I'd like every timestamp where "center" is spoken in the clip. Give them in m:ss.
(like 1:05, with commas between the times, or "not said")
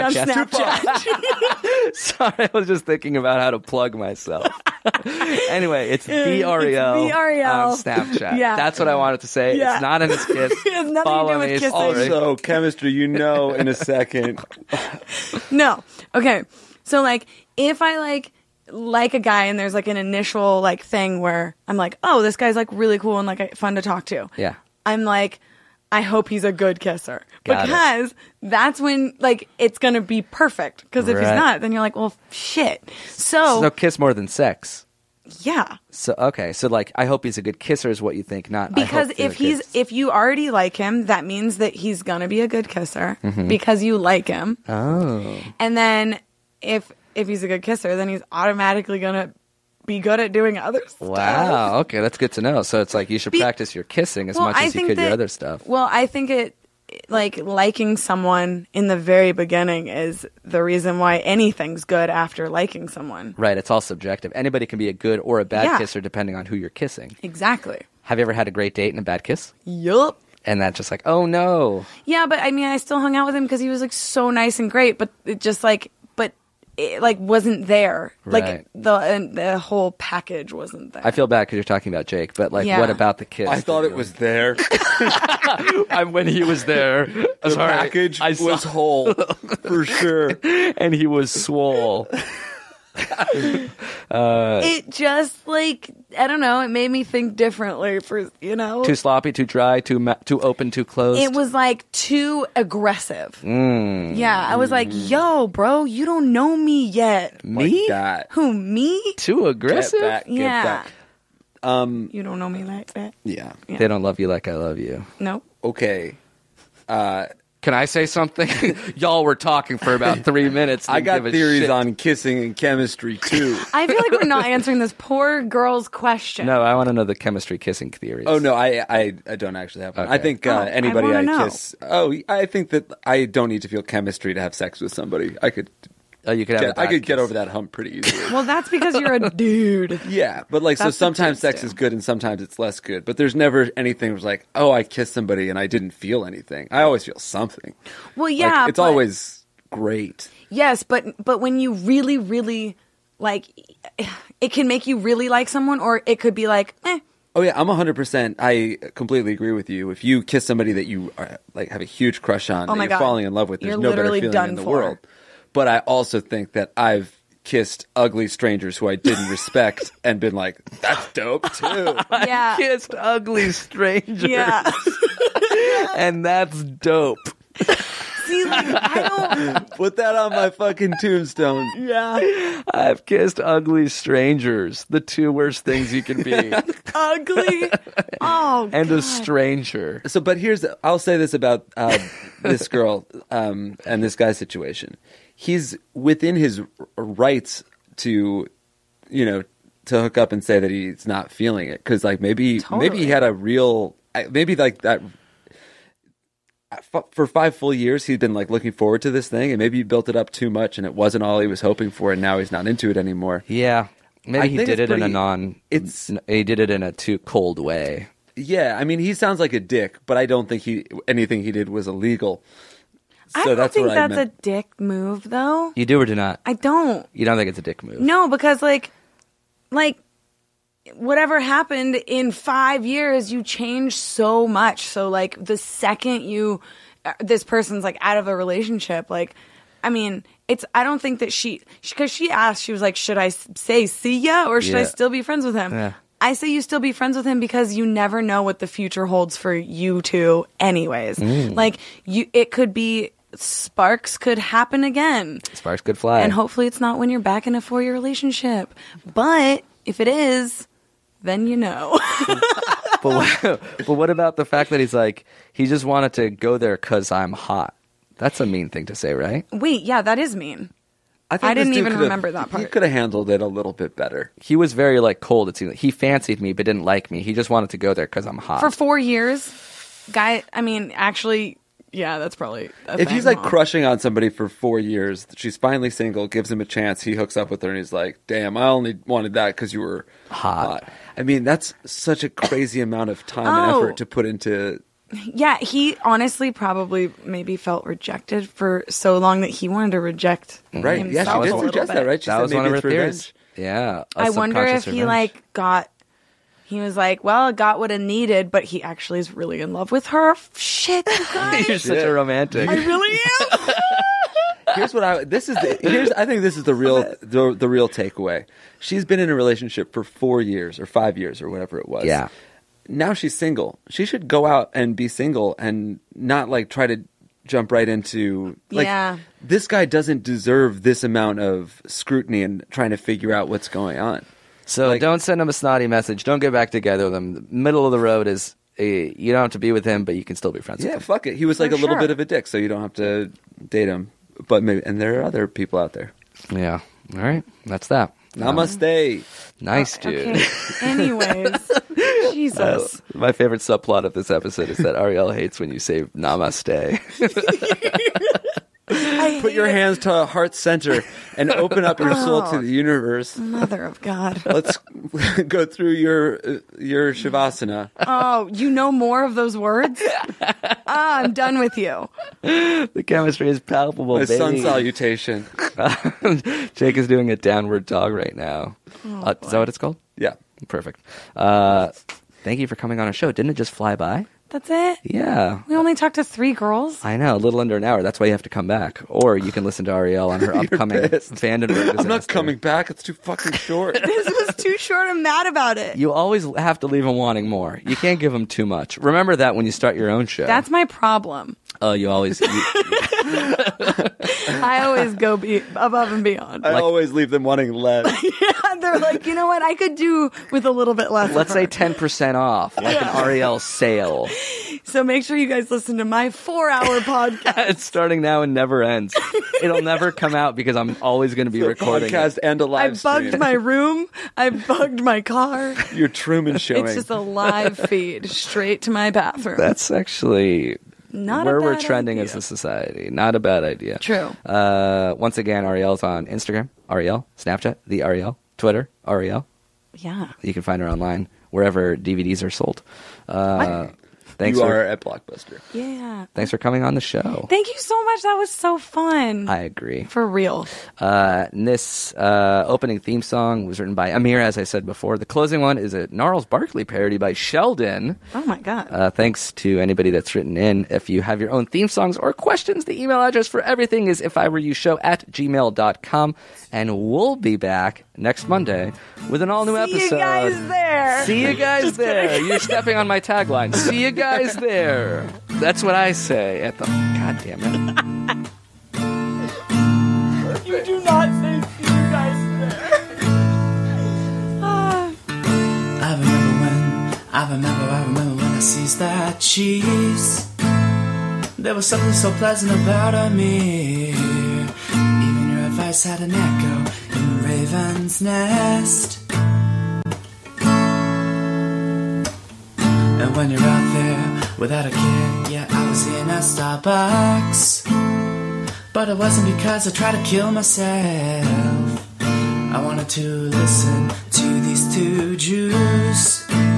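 6:00.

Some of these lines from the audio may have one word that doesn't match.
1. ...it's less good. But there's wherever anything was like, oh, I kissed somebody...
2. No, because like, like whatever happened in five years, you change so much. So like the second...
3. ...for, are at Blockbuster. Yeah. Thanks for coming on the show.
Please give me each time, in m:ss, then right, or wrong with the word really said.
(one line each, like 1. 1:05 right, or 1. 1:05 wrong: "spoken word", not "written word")
1. 2:22 wrong: "never", not "wherever"
2. 3:47 right
3. 7:24 right.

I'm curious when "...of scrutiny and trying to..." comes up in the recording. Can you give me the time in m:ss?
5:31.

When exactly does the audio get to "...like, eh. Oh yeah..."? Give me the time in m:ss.
2:36.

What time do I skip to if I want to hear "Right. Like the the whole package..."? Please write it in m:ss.
1:18.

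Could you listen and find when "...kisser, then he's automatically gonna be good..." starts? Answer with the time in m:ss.
0:47.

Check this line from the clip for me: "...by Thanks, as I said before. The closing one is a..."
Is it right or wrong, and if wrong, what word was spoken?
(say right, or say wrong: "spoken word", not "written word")
wrong: "Amir", not "Thanks".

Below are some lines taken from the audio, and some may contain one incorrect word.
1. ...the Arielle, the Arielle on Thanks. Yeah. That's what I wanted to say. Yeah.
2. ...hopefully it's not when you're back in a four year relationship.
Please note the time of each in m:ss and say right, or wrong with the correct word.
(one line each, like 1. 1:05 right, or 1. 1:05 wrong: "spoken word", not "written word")
1. 0:06 wrong: "Snapchat", not "Thanks"
2. 4:16 right.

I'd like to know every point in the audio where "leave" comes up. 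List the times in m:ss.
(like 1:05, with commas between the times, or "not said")
6:36, 6:47.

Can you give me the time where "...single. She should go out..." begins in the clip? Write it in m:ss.
5:23.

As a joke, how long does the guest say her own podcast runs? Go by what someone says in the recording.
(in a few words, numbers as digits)
4 hours.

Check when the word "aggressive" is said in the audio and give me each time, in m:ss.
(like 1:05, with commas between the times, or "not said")
1:42, 1:49.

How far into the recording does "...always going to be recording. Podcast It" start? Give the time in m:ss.
7:00.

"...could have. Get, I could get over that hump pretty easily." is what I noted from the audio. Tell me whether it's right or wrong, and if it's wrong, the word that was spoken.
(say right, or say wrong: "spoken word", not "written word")
right.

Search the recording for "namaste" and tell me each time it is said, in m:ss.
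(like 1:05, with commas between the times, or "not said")
5:48, 5:56.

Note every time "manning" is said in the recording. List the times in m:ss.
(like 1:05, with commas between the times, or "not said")
not said.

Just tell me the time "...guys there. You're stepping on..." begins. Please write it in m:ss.
7:51.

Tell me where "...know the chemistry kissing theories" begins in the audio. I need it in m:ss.
2:06.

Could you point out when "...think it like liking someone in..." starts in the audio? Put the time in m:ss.
0:56.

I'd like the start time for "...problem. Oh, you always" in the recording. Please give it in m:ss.
6:40.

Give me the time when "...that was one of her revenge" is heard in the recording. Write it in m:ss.
5:02.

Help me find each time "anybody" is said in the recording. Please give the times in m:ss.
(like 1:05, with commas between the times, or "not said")
1:04, 2:10, 7:39.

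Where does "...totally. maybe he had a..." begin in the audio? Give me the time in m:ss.
3:22.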